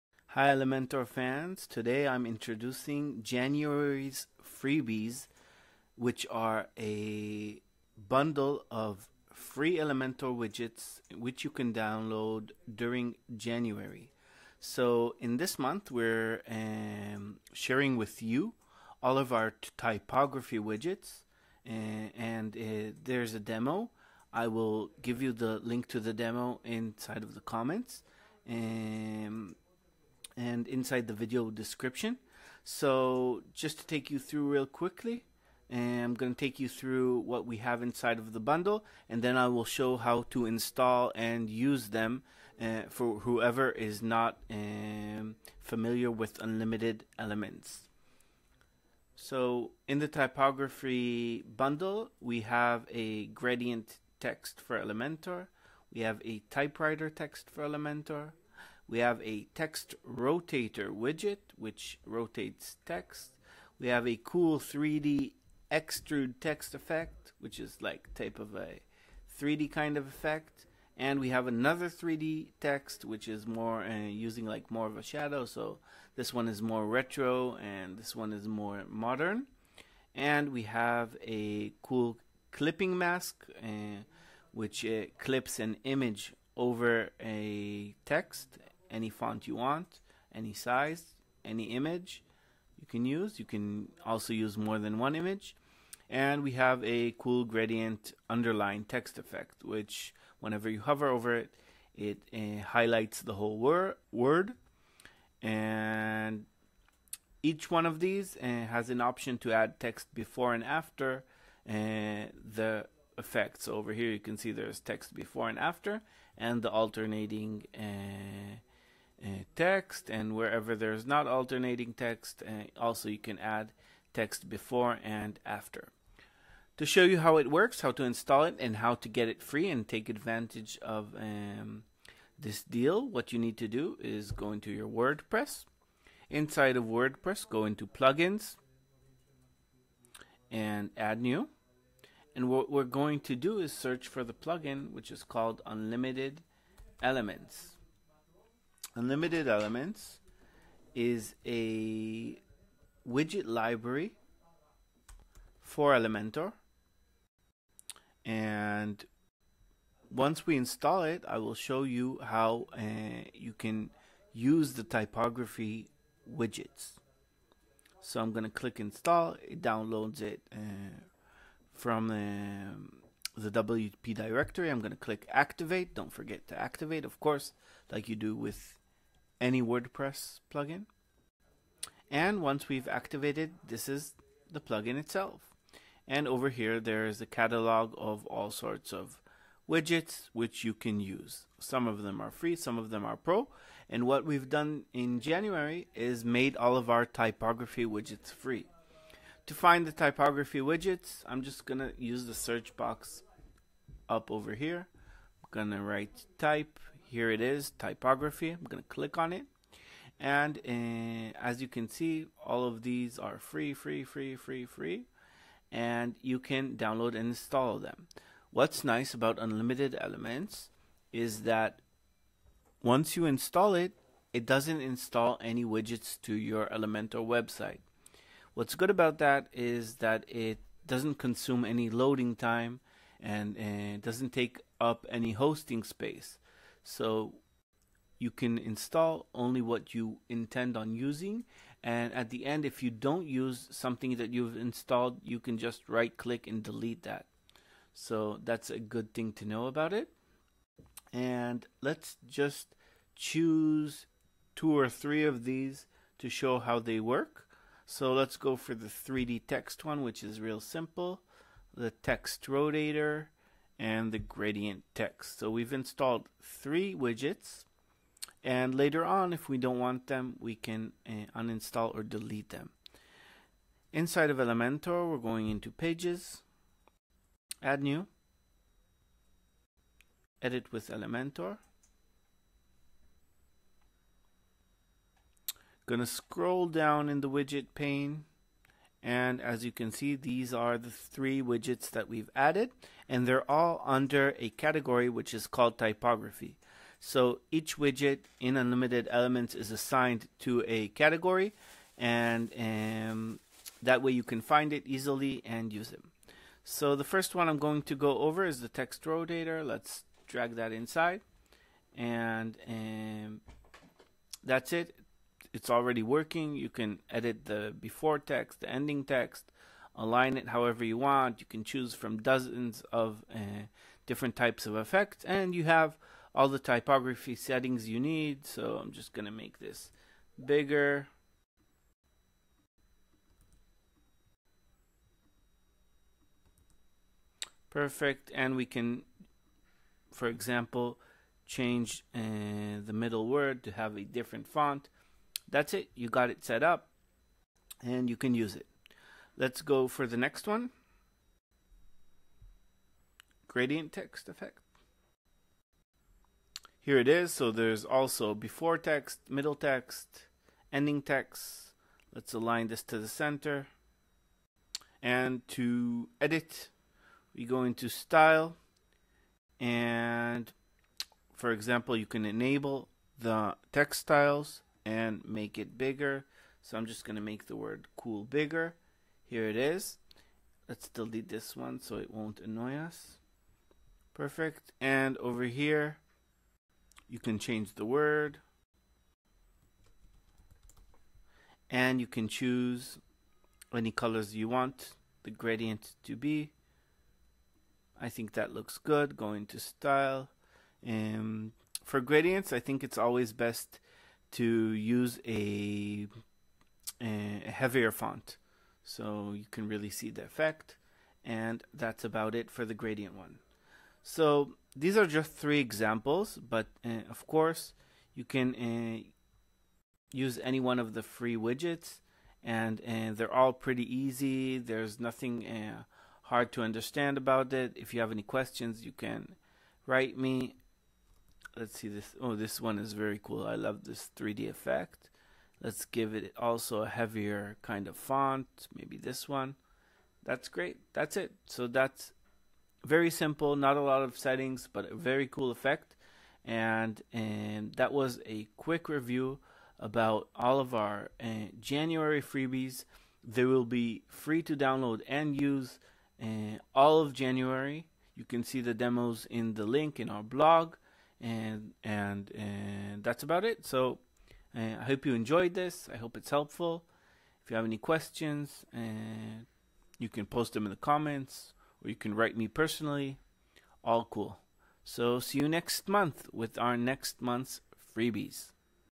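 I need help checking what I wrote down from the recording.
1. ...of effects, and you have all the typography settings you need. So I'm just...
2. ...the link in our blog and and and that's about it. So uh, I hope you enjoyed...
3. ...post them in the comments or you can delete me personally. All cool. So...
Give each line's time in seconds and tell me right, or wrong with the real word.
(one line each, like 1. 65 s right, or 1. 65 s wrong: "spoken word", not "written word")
1. 324 s right
2. 459 s right
3. 470 s wrong: "write", not "delete".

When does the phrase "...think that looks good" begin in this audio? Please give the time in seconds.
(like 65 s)
398 s.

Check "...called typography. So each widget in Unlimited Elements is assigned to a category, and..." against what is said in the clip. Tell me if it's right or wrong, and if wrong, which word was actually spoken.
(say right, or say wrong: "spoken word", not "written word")
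right.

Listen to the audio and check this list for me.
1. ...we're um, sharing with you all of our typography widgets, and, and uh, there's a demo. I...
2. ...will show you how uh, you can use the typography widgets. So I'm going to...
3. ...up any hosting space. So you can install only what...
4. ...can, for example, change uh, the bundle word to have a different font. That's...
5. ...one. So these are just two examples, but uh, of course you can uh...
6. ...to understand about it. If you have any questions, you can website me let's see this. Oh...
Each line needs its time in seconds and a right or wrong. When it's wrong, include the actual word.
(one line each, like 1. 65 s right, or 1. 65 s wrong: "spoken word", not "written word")
1. 15 s right
2. 161 s right
3. 234 s right
4. 338 s wrong: "middle", not "bundle"
5. 413 s wrong: "three", not "two"
6. 426 s wrong: "write", not "website".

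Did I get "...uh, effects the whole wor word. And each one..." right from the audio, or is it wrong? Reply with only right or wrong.
wrong.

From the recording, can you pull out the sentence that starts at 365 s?
And to edit, we go into style and for example, you can enable the text styles and make it bigger.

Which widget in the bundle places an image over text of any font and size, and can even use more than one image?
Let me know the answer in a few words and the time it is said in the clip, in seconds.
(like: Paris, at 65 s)
clipping mask, at 82 s.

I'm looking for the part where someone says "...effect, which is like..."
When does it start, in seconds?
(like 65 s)
66 s.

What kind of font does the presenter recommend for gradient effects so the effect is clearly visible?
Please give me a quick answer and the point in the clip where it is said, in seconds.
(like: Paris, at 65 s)
a heavier font, at 407 s.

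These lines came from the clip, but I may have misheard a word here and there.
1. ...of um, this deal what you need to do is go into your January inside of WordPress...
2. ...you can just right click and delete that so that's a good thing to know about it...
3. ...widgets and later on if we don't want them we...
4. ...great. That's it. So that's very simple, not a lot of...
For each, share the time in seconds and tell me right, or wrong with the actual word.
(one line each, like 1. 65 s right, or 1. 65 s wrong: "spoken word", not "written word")
1. 130 s wrong: "WordPress", not "January"
2. 245 s right
3. 266 s right
4. 440 s right.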